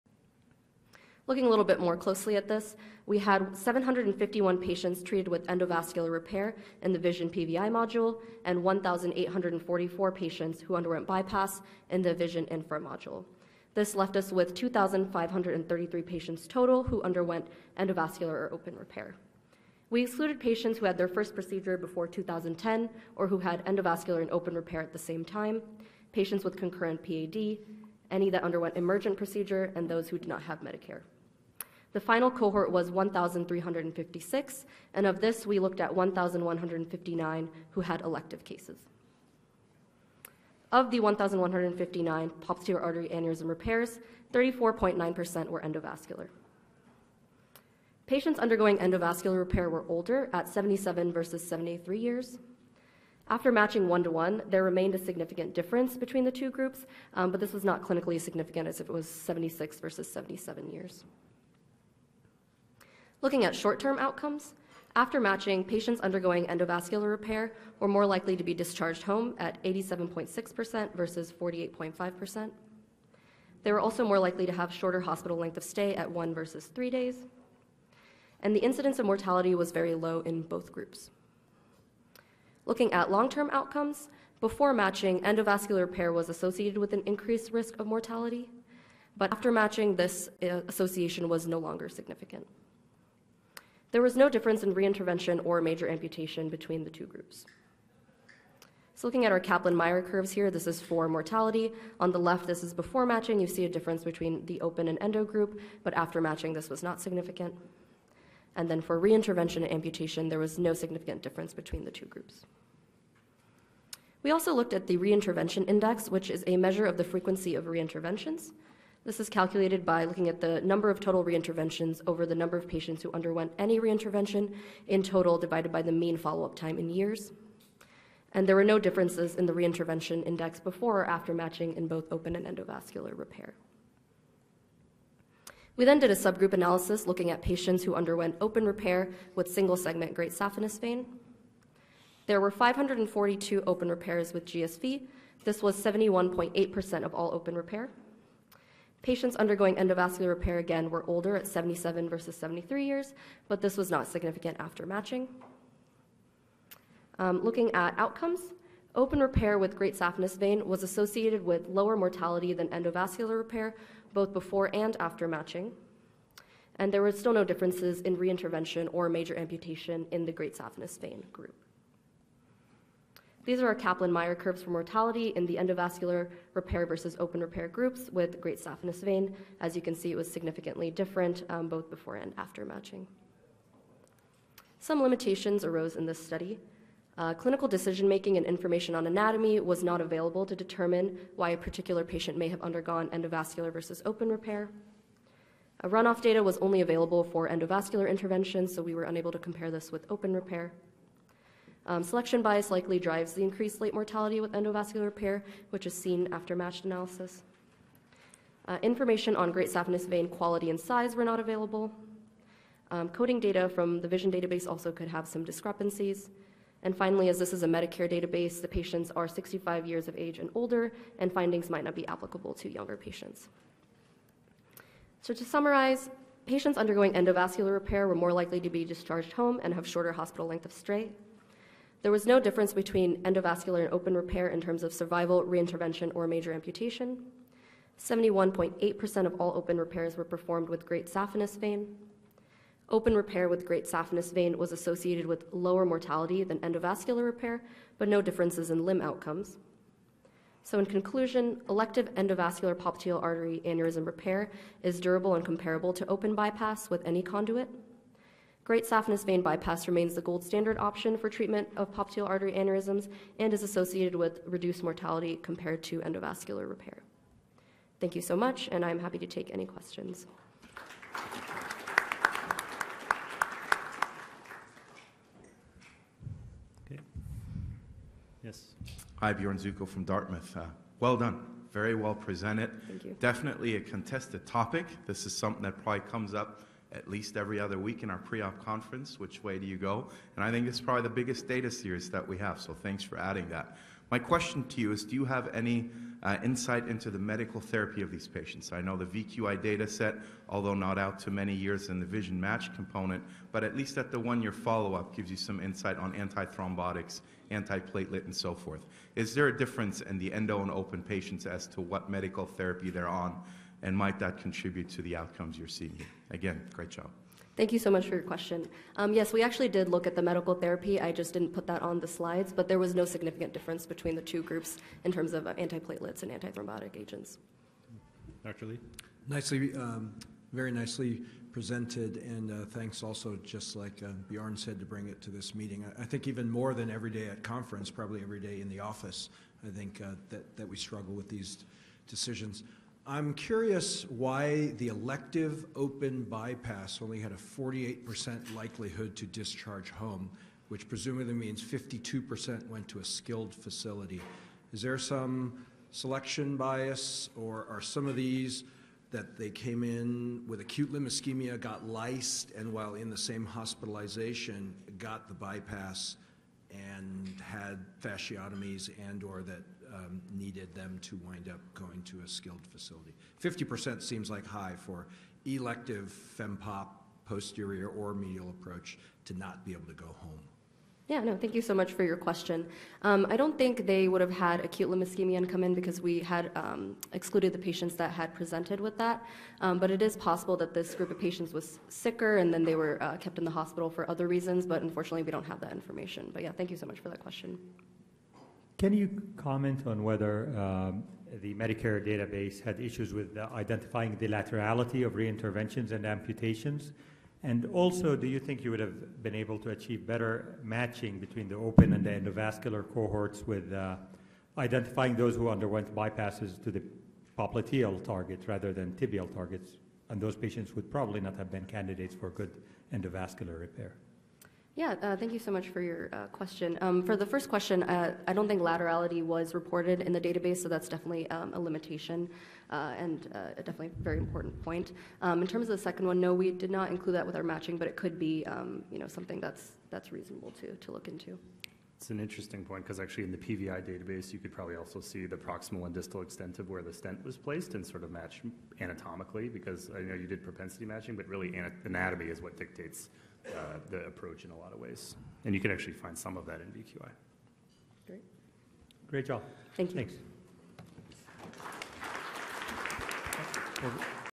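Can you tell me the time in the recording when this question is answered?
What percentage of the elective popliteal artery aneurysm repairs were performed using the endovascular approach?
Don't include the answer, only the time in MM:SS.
00:44.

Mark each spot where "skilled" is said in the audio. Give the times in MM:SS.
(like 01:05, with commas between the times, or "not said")
05:53, 06:12.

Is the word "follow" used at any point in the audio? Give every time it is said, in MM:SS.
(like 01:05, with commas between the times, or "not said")
02:06, 05:04.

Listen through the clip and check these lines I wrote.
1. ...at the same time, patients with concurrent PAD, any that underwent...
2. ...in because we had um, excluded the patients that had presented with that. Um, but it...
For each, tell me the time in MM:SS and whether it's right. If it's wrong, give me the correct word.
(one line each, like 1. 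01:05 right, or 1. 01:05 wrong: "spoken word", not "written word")
1. 00:24 right
2. 06:25 right.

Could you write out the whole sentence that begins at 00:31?
The final cohort was 1,356, and of this, we looked at 1,159 who had elective cases.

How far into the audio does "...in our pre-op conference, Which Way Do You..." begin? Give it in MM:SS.
04:48.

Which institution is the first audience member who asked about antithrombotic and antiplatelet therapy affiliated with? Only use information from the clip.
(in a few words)
Dartmouth.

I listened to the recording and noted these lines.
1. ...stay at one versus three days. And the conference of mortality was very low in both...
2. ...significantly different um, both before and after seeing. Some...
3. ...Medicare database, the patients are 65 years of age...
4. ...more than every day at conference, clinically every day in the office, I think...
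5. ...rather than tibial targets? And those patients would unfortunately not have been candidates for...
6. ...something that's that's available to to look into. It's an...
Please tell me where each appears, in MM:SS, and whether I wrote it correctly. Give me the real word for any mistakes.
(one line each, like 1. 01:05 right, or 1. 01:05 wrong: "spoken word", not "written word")
1. 01:15 wrong: "incidence", not "conference"
2. 03:00 wrong: "matching", not "seeing"
3. 03:37 right
4. 05:36 wrong: "probably", not "clinically"
5. 06:58 wrong: "probably", not "unfortunately"
6. 07:19 wrong: "reasonable", not "available".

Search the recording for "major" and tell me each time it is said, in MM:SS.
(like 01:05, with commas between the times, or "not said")
01:35, 02:49, 03:56.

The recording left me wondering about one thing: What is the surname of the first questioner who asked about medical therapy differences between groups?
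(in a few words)
Suckow.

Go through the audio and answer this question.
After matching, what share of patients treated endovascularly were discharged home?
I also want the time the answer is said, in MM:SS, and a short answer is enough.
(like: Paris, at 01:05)
87.6%, at 01:09.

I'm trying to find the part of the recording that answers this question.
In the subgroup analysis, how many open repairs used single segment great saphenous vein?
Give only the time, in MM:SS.
02:22.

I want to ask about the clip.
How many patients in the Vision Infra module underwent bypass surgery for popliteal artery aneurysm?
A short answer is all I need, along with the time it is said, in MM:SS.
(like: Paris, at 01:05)
1,844, at 00:08.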